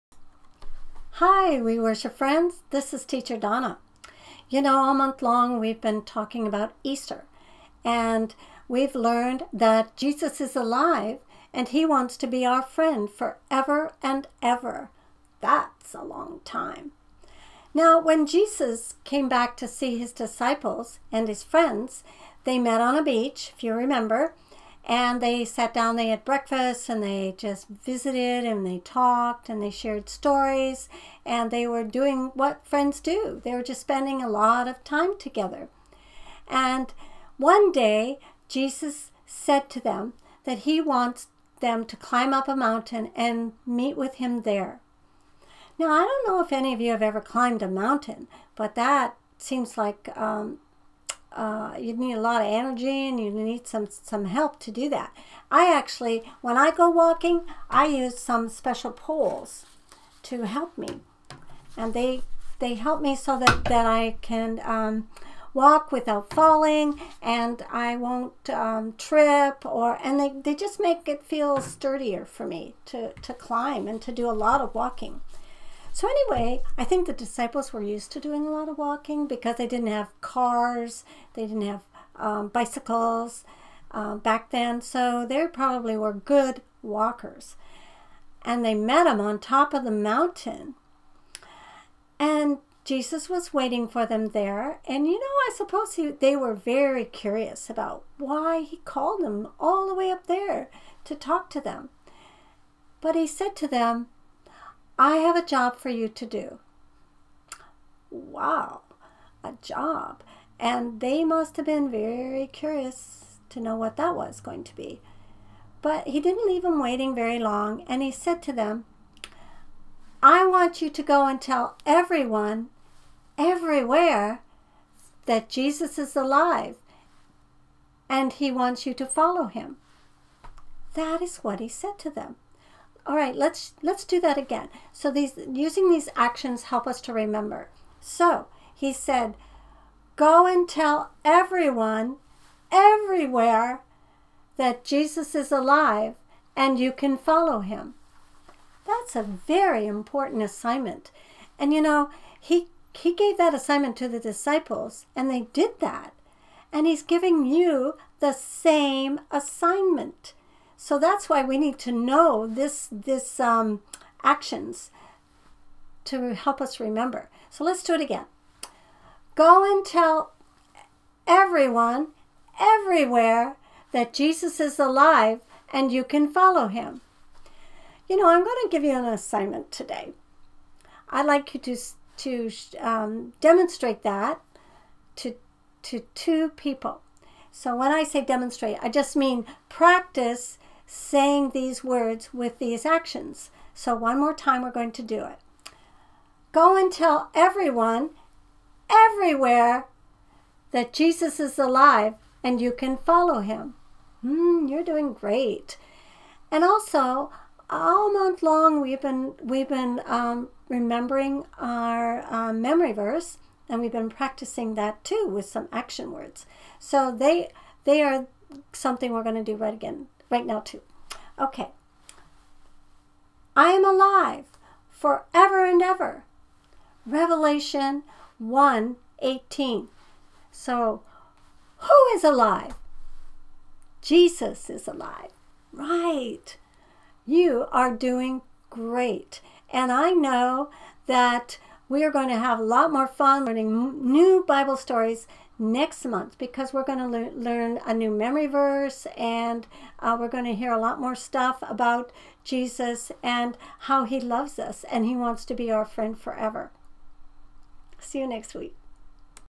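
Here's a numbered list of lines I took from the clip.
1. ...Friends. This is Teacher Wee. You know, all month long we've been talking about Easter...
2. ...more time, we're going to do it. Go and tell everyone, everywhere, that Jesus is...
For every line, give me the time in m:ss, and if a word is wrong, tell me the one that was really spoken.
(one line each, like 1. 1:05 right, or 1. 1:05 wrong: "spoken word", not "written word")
1. 0:02 wrong: "Donna", not "Wee"
2. 3:14 right.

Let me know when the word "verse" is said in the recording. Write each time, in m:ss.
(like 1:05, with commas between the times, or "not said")
3:32, 4:08.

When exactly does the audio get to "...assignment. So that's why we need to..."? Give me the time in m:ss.
2:39.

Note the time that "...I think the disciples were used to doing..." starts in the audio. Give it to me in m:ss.
1:16.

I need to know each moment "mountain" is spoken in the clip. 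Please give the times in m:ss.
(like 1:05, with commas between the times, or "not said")
0:42, 0:47, 1:29.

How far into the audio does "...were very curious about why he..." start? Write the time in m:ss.
1:36.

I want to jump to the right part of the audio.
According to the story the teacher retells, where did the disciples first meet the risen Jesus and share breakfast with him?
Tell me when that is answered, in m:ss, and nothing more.
0:22.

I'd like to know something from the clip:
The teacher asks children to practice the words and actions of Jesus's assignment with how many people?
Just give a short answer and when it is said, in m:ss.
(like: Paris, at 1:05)
2, at 3:06.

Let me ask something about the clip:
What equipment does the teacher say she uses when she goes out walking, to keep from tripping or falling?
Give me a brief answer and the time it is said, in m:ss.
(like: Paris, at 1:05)
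Special poles, at 0:58.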